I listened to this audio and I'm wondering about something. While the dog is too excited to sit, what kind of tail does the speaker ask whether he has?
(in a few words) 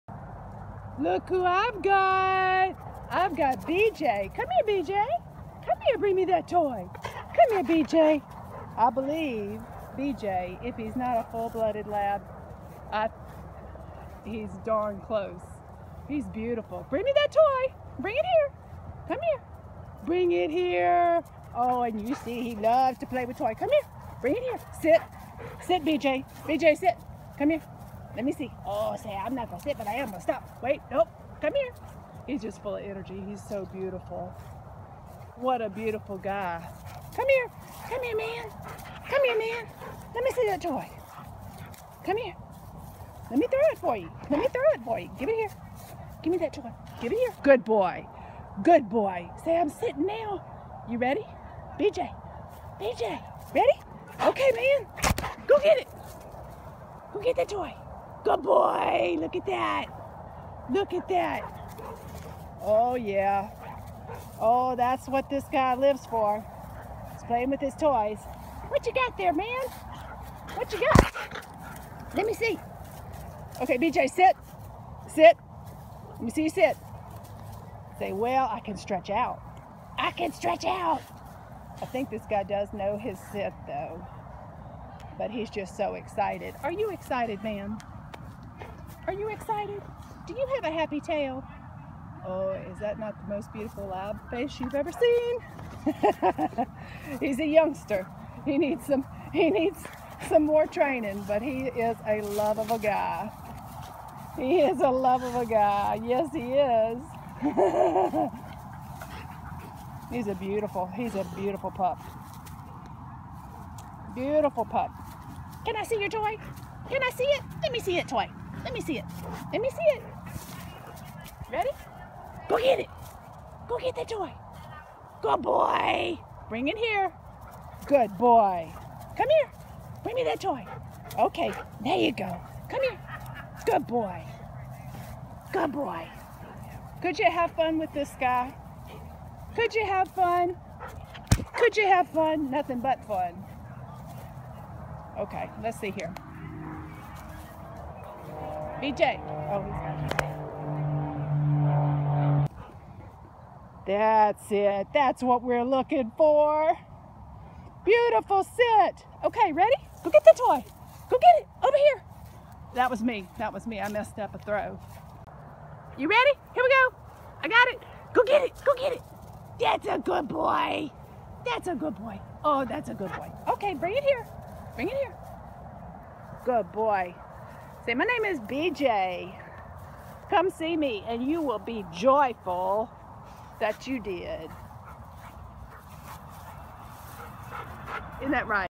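A happy tail.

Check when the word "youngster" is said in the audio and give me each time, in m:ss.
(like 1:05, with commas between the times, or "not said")
1:37.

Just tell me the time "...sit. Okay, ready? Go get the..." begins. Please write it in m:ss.
2:38.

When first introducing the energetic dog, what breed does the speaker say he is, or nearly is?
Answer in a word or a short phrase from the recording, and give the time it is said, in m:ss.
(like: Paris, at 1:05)
Full-blooded lab, at 0:11.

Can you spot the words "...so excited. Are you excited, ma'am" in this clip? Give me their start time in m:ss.
1:25.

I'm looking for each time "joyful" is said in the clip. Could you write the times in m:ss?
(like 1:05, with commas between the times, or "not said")
3:01.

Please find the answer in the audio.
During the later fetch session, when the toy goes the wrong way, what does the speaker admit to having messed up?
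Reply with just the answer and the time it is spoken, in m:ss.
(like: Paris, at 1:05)
A throw, at 2:43.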